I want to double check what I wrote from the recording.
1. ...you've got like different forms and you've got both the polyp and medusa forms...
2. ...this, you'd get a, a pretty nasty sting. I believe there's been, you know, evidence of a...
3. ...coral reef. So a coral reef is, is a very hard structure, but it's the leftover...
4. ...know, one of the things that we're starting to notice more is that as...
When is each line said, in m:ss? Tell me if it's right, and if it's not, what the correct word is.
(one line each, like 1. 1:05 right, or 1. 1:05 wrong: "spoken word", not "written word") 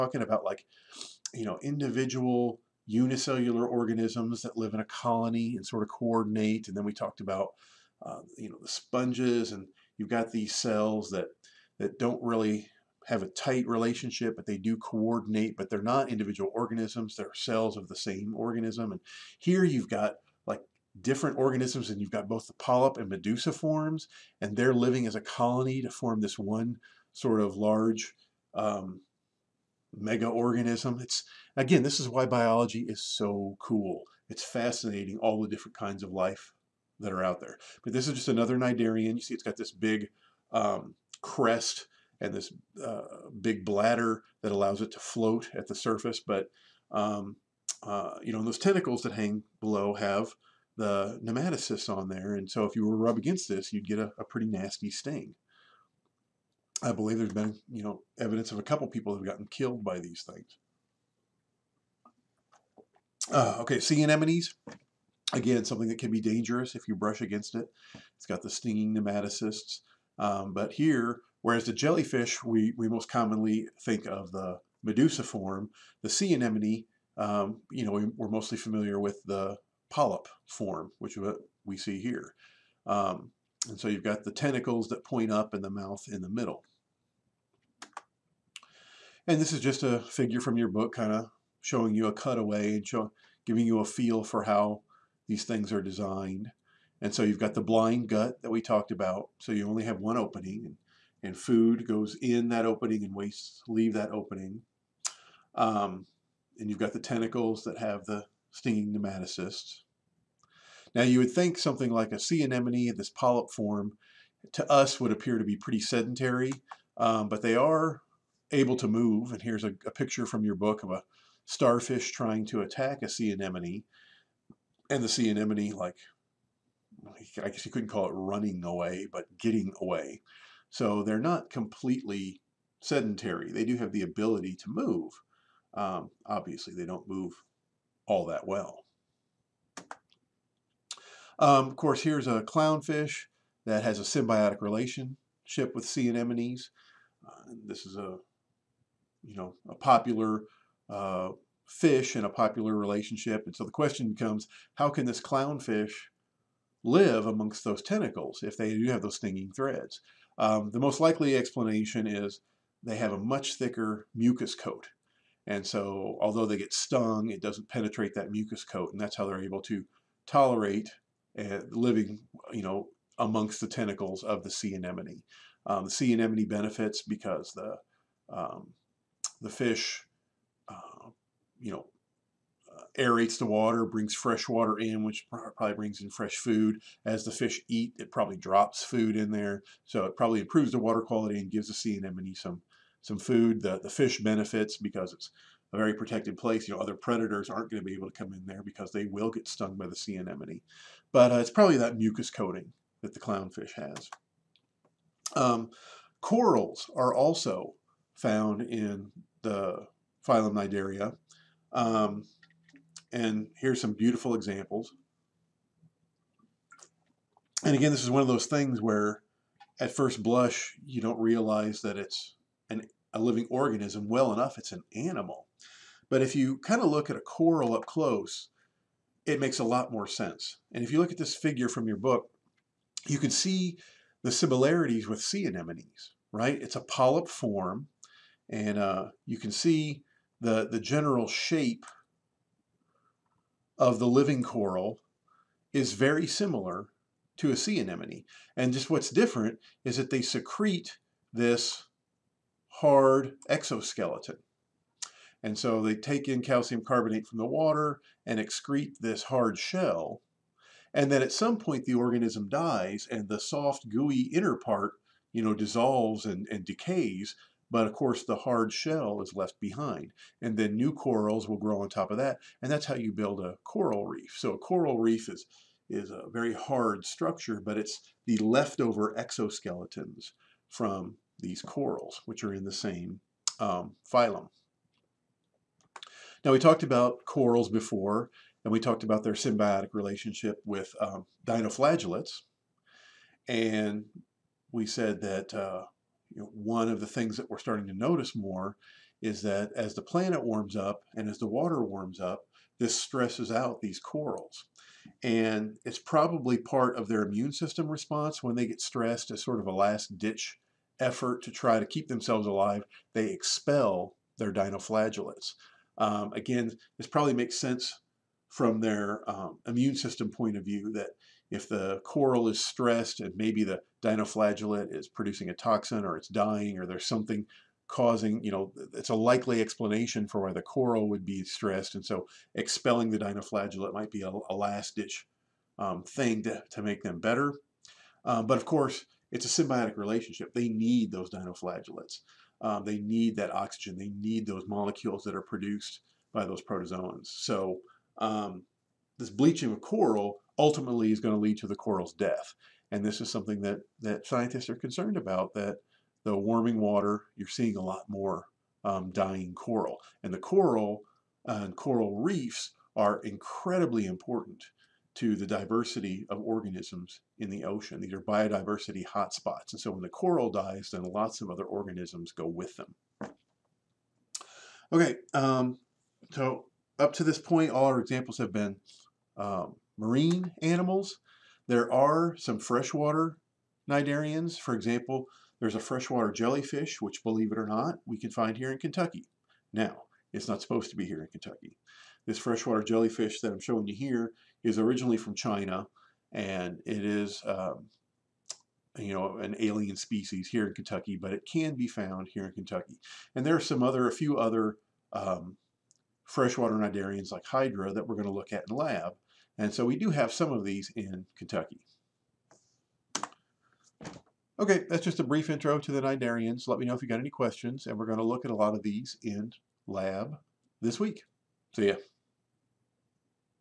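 1. 0:19 wrong: "organisms", not "forms"
2. 0:53 right
3. 4:33 right
4. 4:56 right.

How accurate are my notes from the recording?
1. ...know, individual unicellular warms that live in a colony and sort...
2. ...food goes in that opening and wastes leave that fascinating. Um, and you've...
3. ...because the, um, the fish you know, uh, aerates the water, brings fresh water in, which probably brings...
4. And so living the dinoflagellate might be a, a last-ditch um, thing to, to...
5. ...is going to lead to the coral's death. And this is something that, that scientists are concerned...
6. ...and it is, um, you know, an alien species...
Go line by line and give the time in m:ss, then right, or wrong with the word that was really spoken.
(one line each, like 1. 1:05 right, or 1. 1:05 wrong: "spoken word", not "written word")
1. 0:01 wrong: "organisms", not "warms"
2. 1:41 wrong: "opening", not "fascinating"
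3. 2:57 right
4. 5:31 wrong: "expelling", not "living"
5. 5:51 right
6. 6:36 right.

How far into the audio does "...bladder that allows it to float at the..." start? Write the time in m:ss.
0:43.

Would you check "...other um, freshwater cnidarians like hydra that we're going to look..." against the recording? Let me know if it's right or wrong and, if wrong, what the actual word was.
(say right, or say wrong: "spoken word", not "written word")
right.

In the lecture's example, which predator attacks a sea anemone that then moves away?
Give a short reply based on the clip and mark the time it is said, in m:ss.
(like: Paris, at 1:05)
Starfish, at 2:01.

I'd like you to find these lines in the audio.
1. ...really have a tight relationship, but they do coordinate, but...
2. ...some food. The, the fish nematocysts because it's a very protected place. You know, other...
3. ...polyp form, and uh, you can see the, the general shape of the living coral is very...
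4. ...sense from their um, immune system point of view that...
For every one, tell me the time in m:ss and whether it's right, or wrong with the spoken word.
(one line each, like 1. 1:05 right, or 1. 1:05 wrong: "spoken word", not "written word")
1. 0:12 right
2. 3:13 wrong: "benefits", not "nematocysts"
3. 3:56 right
4. 5:17 right.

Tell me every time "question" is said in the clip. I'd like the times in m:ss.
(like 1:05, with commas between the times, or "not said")
2:33, 6:57.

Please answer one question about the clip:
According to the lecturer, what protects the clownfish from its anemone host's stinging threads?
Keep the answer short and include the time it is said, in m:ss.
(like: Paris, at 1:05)
Thicker mucus coat, at 2:43.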